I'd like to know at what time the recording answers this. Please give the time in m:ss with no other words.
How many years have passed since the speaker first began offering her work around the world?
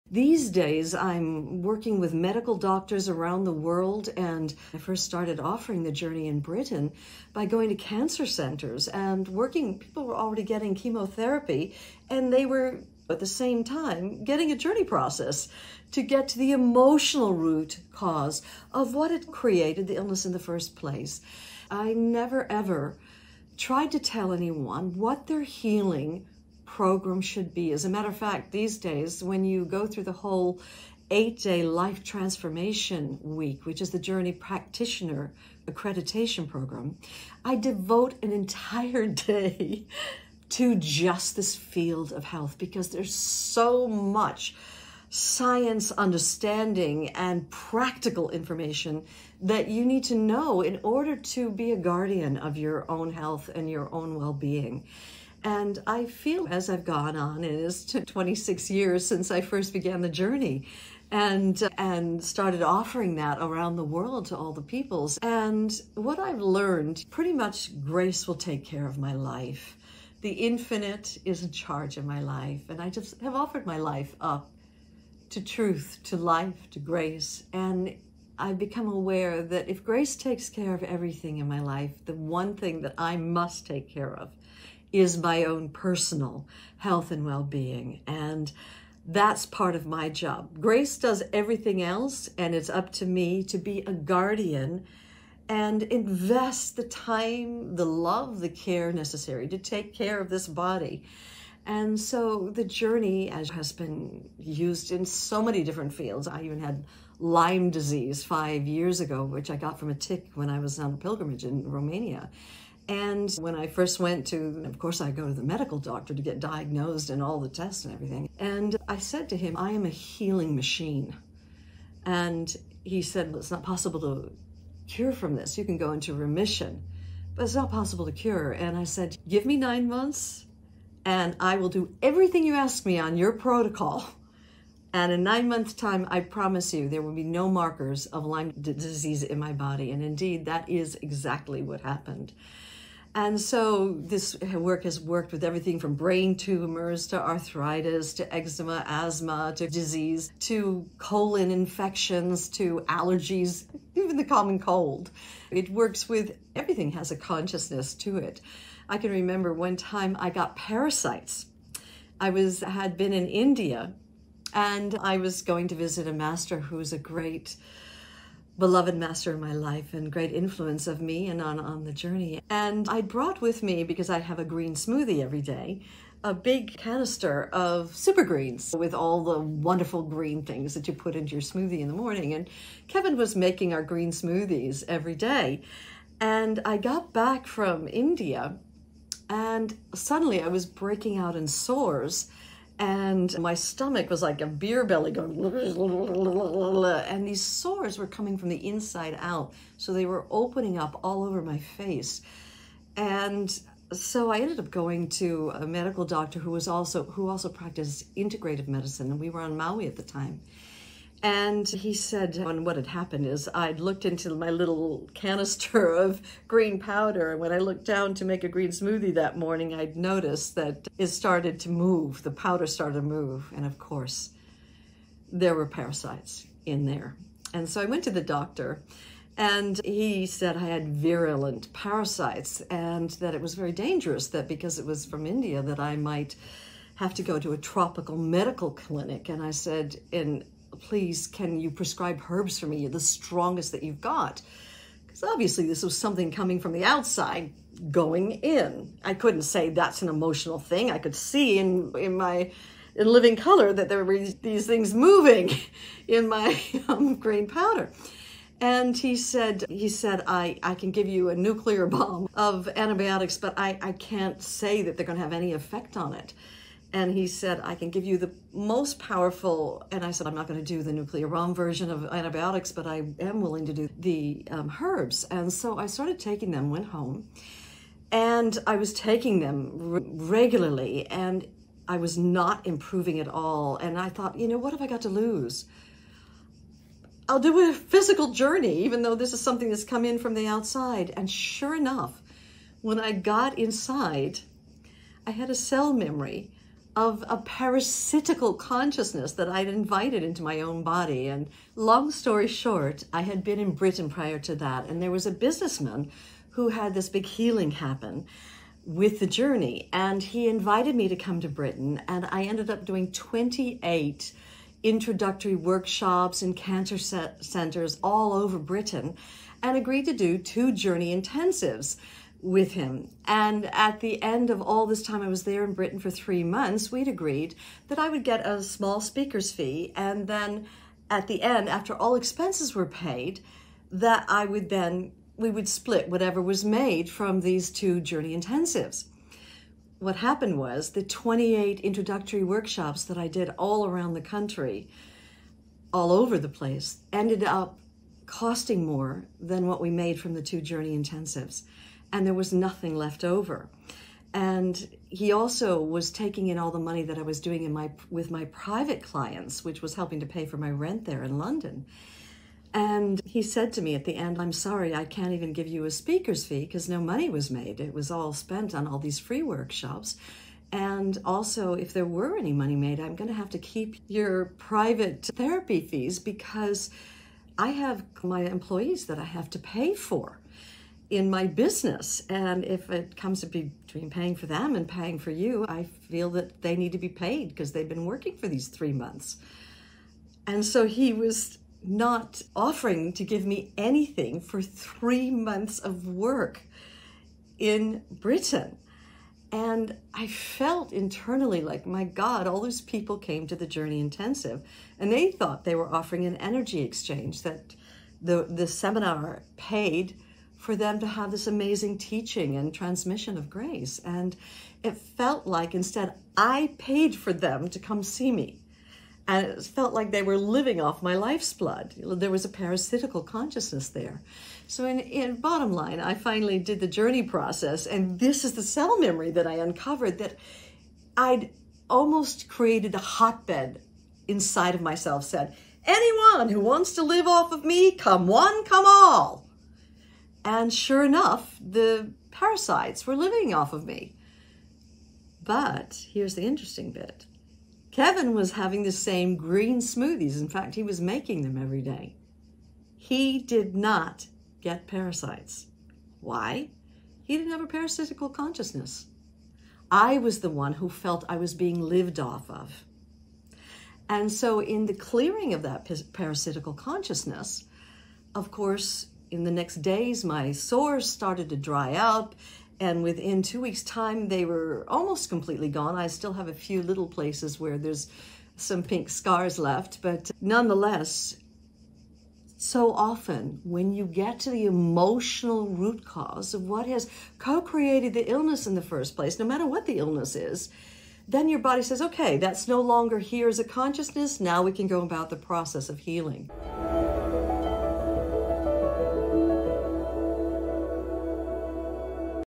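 0:57.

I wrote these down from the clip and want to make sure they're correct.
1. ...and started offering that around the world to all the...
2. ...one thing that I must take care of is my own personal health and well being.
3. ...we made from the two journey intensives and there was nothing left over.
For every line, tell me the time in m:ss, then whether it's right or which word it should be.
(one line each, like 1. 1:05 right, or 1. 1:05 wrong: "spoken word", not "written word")
1. 1:01 right
2. 1:22 right
3. 5:49 right.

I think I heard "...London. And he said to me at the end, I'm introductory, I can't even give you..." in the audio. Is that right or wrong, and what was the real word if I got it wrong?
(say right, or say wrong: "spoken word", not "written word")
wrong: "sorry", not "introductory".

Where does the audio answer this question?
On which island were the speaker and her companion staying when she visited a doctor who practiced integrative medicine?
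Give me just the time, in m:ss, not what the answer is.
3:29.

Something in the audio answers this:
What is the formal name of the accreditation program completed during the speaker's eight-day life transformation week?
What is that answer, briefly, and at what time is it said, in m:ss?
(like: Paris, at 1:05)
Journey Practitioner accreditation program, at 0:33.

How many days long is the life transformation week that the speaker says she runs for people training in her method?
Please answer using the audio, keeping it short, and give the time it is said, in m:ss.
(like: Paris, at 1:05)
8, at 0:31.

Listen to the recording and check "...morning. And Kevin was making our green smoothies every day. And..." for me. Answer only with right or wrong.
right.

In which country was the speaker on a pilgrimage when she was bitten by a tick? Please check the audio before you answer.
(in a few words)
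Romania.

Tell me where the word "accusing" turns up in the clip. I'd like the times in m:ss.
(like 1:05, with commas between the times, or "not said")
not said.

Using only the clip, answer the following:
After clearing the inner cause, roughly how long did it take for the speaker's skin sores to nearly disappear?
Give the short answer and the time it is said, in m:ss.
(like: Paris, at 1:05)
2 weeks, at 7:53.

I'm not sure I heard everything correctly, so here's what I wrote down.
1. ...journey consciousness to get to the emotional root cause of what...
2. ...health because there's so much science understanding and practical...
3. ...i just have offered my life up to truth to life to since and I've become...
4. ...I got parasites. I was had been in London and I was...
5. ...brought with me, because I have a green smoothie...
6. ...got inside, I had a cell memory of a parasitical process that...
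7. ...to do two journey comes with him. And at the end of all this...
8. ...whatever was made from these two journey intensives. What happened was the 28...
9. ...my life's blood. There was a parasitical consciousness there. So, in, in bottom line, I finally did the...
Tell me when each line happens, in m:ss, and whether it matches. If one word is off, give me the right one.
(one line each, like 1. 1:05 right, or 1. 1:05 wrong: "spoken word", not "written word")
1. 0:14 wrong: "process", not "consciousness"
2. 0:42 right
3. 1:12 wrong: "grace", not "since"
4. 2:40 wrong: "India", not "London"
5. 2:53 right
6. 4:53 wrong: "consciousness", not "process"
7. 5:20 wrong: "intensives", not "comes"
8. 5:36 right
9. 7:01 right.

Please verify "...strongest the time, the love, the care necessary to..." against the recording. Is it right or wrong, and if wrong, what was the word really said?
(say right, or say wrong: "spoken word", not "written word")
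wrong: "invest", not "strongest".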